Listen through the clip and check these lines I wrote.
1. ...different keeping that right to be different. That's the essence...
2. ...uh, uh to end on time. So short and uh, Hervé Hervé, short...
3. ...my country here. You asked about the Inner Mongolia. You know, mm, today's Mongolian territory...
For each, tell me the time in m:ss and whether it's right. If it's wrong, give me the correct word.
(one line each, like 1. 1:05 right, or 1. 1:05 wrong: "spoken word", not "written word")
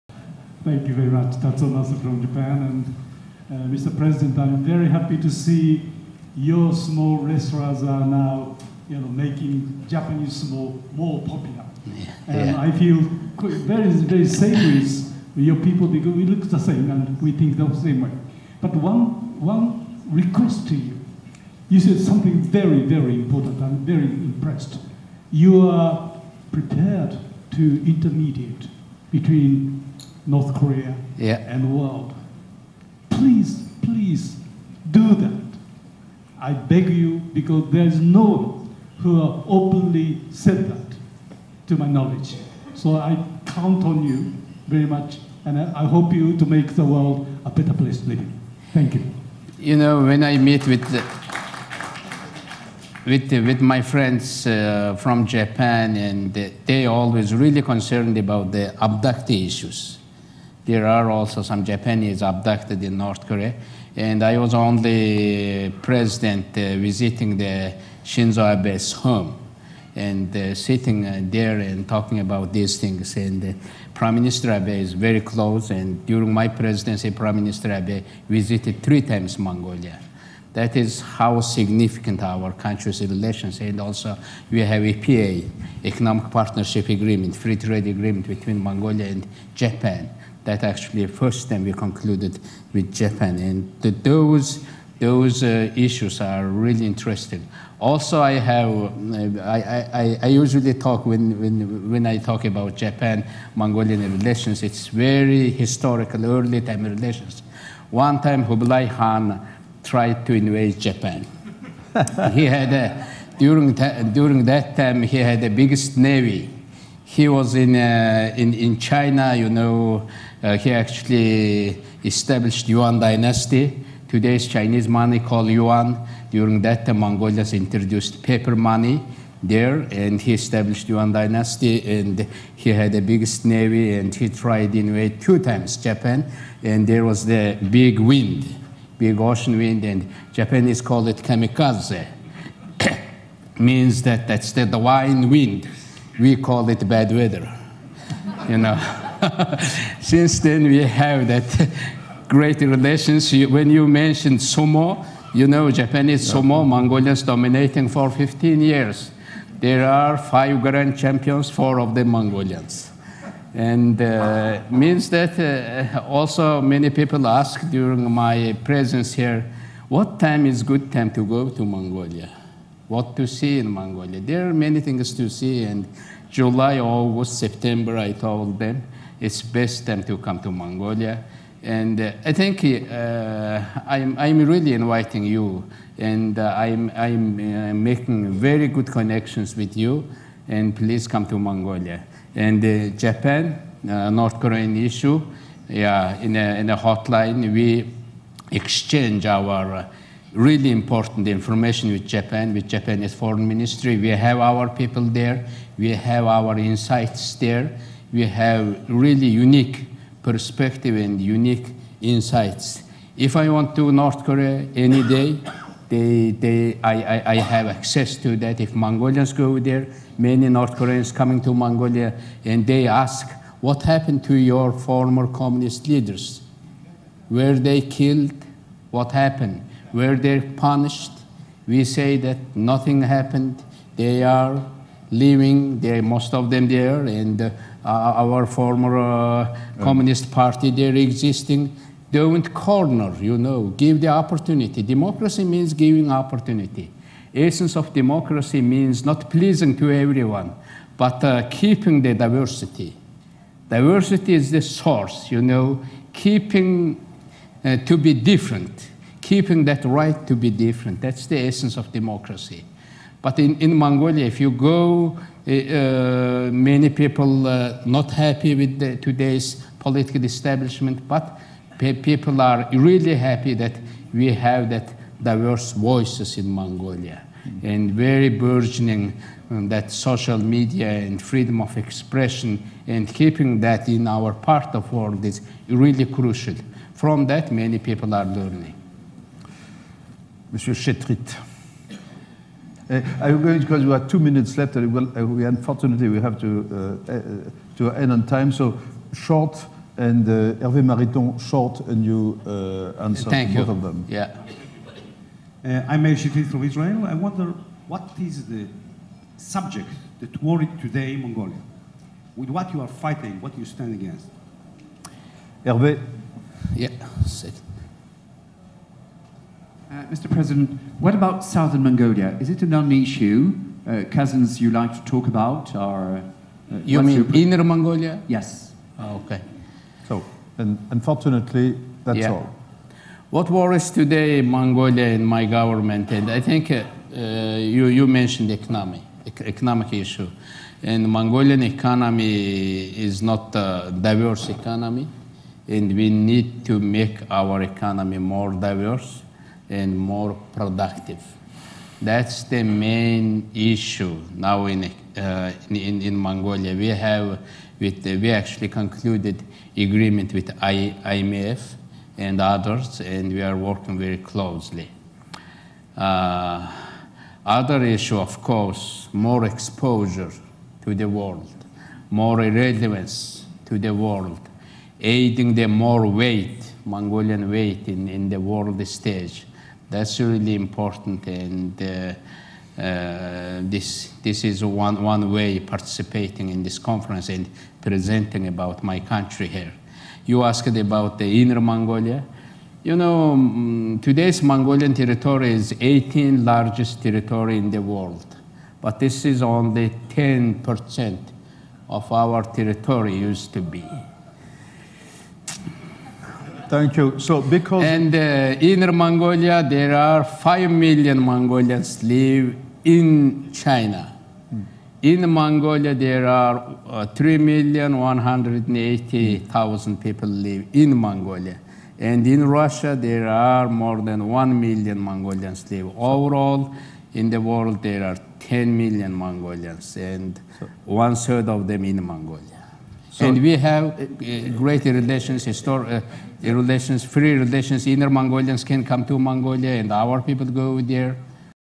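1. 4:18 right
2. 4:57 wrong: "Mariton", not "Hervé"
3. 6:28 right.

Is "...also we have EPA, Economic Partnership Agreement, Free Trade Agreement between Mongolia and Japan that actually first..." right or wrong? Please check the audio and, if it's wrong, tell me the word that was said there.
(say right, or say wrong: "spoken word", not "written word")
right.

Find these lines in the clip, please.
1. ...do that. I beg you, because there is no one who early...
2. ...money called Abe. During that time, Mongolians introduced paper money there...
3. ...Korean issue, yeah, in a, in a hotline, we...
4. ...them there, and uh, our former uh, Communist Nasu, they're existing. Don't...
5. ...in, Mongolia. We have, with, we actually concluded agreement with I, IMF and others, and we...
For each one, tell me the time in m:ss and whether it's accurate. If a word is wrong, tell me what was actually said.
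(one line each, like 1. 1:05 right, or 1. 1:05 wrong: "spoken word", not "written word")
1. 0:34 wrong: "openly", not "early"
2. 2:04 wrong: "Yuan", not "Abe"
3. 3:14 right
4. 3:56 wrong: "Party", not "Nasu"
5. 5:56 right.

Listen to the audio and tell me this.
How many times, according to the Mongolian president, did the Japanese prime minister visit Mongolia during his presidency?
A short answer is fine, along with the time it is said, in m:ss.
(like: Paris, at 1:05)
3, at 1:18.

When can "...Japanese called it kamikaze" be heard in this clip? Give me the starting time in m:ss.
2:20.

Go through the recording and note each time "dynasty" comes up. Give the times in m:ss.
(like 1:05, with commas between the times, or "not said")
2:03, 2:11.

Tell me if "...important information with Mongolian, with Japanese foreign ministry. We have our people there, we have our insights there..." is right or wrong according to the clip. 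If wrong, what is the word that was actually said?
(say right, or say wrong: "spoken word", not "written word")
wrong: "Japan", not "Mongolian".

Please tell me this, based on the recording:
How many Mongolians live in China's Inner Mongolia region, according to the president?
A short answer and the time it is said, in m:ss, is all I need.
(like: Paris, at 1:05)
5 million, at 6:50.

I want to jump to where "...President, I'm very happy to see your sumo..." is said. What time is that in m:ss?
0:03.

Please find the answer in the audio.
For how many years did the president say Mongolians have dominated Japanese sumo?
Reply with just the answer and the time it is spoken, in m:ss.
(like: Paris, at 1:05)
15, at 2:38.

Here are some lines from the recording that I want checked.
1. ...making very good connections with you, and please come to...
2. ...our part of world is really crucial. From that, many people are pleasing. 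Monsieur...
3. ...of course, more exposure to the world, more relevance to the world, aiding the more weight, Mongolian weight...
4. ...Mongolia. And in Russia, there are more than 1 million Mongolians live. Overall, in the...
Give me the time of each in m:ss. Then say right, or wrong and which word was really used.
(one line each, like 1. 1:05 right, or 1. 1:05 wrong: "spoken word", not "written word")
1. 3:07 right
2. 4:44 wrong: "learning", not "pleasing"
3. 6:08 right
4. 7:00 right.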